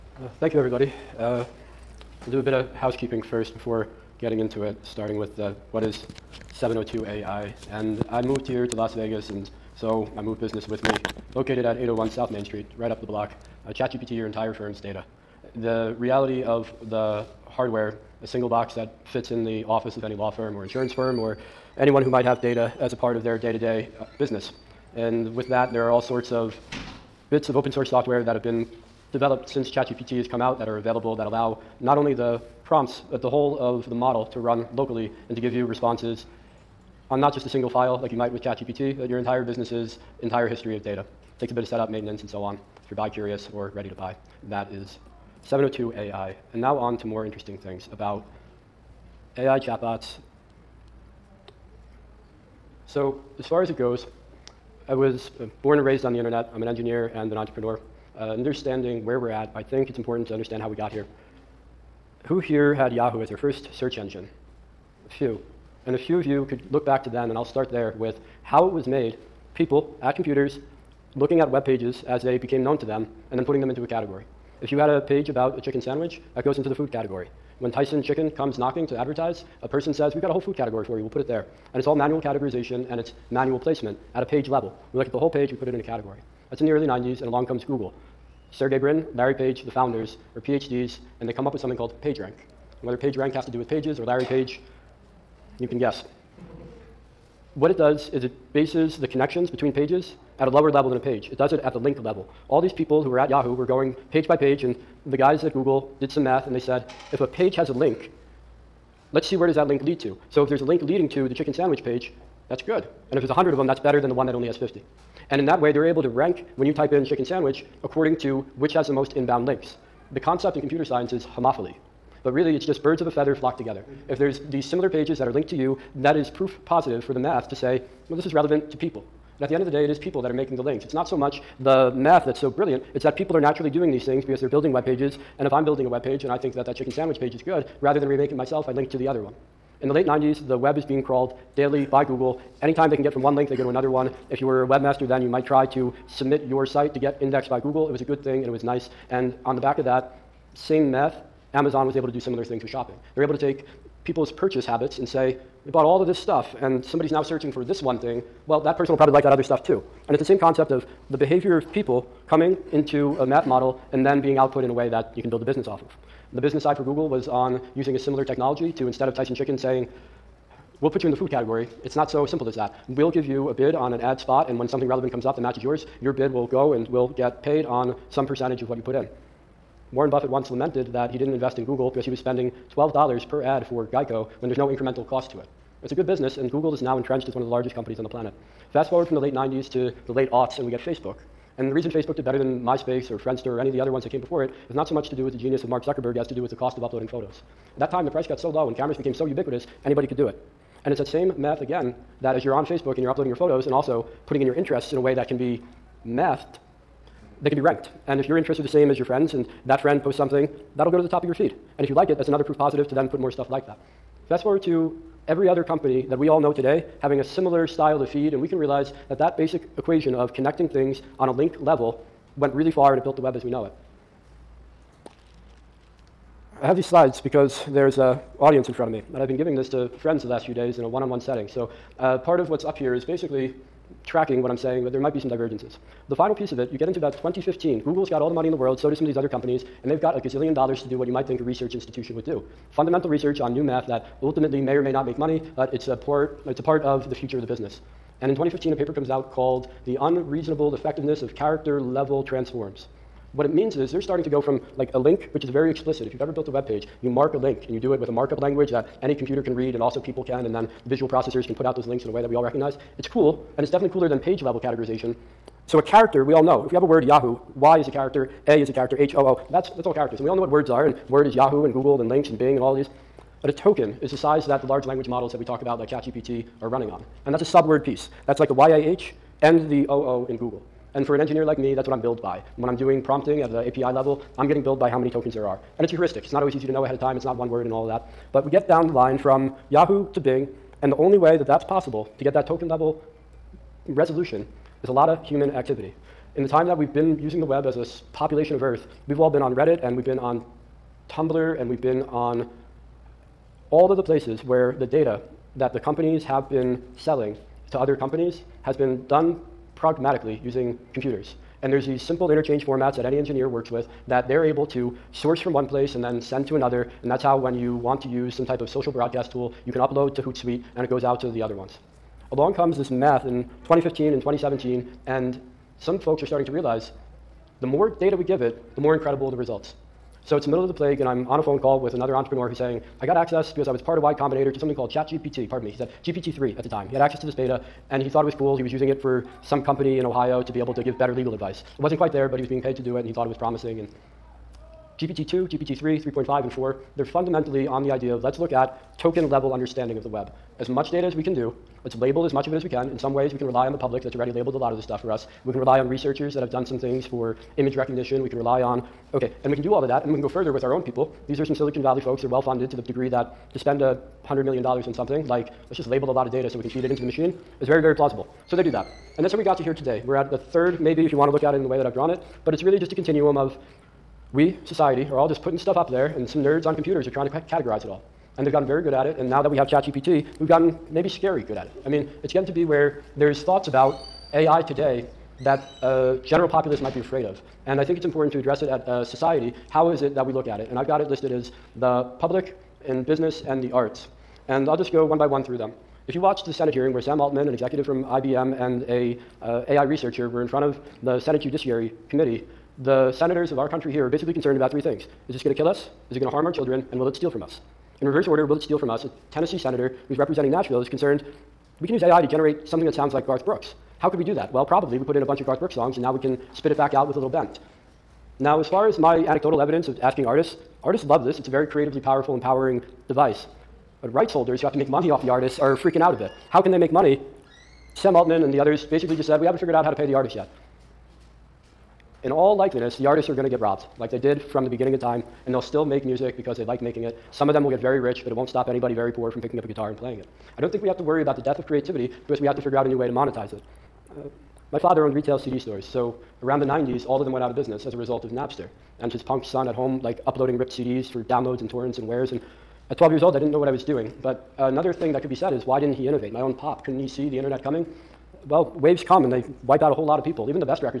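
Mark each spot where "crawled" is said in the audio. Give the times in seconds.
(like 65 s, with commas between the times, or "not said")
141 s.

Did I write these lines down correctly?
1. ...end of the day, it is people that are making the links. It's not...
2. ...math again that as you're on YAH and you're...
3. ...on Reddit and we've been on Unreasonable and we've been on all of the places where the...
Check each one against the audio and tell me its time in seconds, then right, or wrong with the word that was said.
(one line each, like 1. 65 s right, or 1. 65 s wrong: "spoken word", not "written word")
1. 129 s right
2. 201 s wrong: "Facebook", not "YAH"
3. 299 s wrong: "Tumblr", not "Unreasonable".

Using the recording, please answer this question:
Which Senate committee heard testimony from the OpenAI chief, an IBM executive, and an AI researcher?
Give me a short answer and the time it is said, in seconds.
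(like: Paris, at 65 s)
Senate Judiciary Committee, at 401 s.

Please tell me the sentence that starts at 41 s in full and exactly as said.
It takes a bit of setup, maintenance, and so on if you're buy curious or ready to buy.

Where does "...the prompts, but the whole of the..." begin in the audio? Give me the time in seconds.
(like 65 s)
32 s.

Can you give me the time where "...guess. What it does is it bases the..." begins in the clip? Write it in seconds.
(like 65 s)
95 s.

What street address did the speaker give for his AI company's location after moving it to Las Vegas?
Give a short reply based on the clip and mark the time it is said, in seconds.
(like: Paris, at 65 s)
801 South Main Street, at 11 s.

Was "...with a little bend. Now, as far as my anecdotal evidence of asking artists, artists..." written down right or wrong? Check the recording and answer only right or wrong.
right.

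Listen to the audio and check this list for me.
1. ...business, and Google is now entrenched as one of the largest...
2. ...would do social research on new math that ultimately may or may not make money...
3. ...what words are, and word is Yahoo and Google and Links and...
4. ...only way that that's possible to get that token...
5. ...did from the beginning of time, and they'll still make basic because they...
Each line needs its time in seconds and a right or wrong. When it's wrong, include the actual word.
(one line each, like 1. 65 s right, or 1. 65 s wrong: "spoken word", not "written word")
1. 186 s right
2. 242 s wrong: "fundamental", not "social"
3. 270 s right
4. 290 s right
5. 434 s wrong: "music", not "basic".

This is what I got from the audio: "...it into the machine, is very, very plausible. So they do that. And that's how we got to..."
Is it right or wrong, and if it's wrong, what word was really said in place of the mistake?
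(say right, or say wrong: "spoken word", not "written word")
right.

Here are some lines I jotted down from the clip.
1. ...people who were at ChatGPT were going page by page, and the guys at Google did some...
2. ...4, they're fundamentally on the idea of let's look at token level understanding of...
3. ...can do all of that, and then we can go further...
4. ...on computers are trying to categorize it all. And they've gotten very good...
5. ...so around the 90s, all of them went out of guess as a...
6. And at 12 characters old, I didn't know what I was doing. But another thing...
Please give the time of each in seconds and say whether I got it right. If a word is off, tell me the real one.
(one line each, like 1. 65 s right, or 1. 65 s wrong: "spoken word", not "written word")
1. 102 s wrong: "Yahoo", not "ChatGPT"
2. 346 s right
3. 359 s right
4. 376 s right
5. 445 s wrong: "business", not "guess"
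6. 452 s wrong: "years", not "characters".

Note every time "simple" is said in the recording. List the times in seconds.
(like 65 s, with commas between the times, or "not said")
172 s, 312 s.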